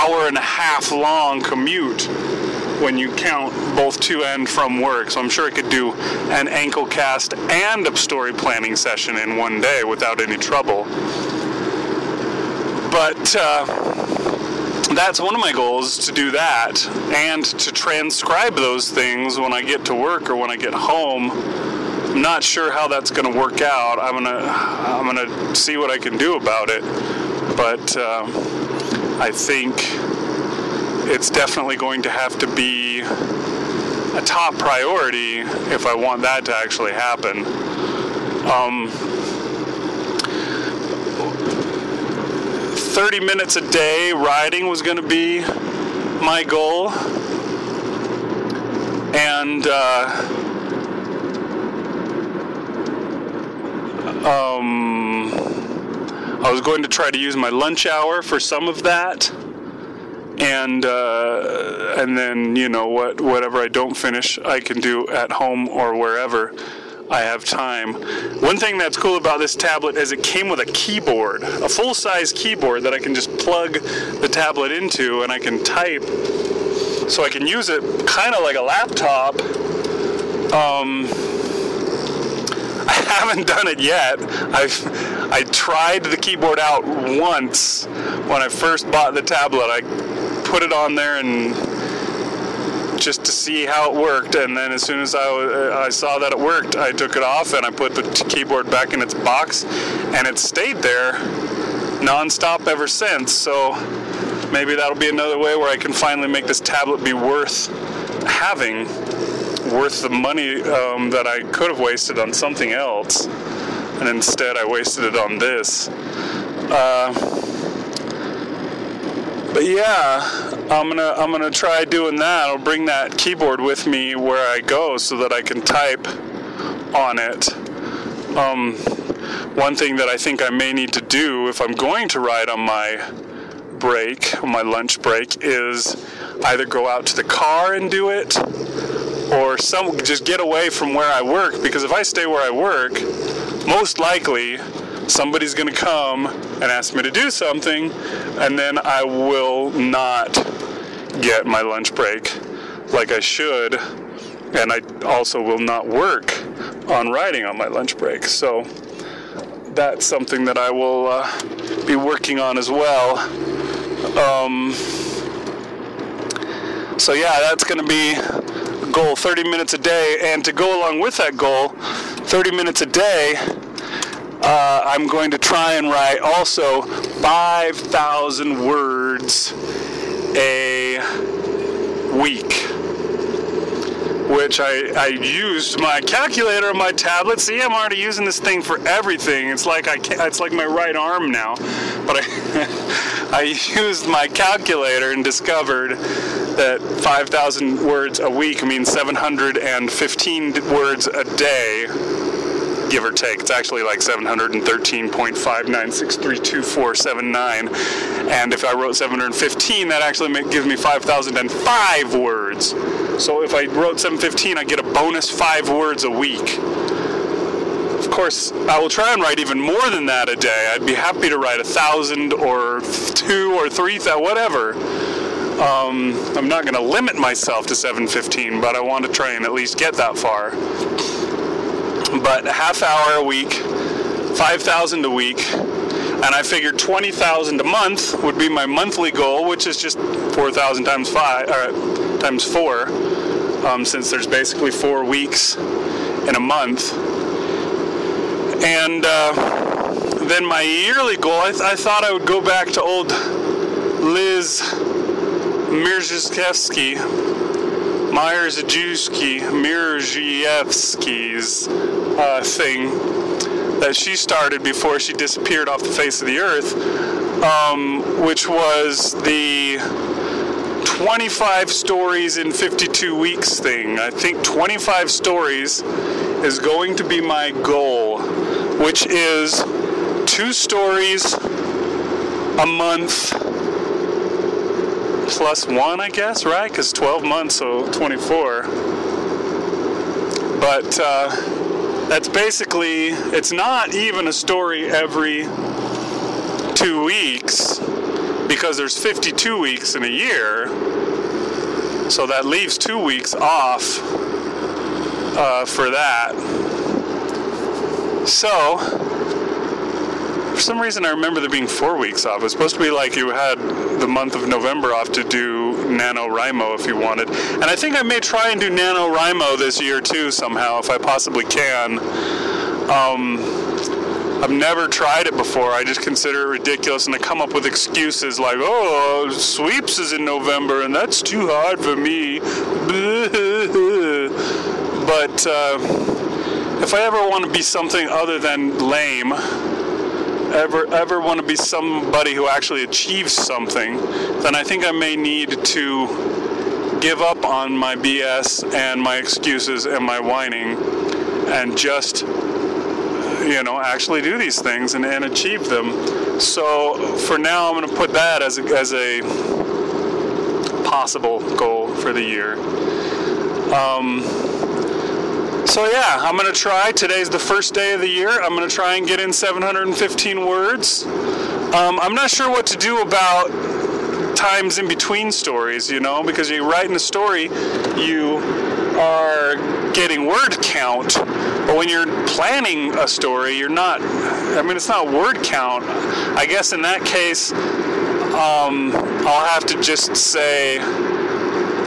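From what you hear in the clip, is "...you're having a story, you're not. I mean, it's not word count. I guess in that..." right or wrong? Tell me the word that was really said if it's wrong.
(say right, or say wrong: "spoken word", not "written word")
wrong: "planning", not "having".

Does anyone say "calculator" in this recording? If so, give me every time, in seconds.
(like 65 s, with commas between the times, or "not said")
186 s, 194 s.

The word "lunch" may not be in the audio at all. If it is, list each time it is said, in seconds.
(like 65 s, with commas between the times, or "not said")
57 s, 134 s, 151 s, 157 s.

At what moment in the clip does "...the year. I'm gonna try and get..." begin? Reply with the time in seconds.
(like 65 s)
368 s.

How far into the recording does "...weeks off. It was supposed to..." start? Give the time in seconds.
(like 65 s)
311 s.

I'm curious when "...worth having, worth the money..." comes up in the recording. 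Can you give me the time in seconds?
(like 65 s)
107 s.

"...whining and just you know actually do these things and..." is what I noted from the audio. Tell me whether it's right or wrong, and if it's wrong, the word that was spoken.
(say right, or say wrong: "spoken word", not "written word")
right.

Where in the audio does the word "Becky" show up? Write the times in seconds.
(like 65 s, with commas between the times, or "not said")
not said.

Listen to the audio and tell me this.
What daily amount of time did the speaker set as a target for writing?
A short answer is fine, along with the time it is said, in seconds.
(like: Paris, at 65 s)
30 minutes, at 38 s.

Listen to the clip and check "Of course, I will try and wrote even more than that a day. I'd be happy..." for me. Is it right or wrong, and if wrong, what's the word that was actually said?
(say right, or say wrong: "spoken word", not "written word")
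wrong: "write", not "wrote".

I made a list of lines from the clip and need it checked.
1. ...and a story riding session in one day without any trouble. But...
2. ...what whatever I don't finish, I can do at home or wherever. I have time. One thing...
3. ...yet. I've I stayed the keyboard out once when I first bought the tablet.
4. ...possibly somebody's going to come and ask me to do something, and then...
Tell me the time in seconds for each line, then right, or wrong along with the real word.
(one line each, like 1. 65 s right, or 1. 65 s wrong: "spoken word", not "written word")
1. 7 s wrong: "planning", not "riding"
2. 62 s right
3. 83 s wrong: "tried", not "stayed"
4. 143 s wrong: "likely", not "possibly".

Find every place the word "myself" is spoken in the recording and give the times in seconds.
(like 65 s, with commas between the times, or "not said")
227 s.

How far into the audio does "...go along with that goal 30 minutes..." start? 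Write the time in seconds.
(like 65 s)
170 s.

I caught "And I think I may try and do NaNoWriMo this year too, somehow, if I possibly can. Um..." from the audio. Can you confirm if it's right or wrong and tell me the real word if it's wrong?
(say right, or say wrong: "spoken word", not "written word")
right.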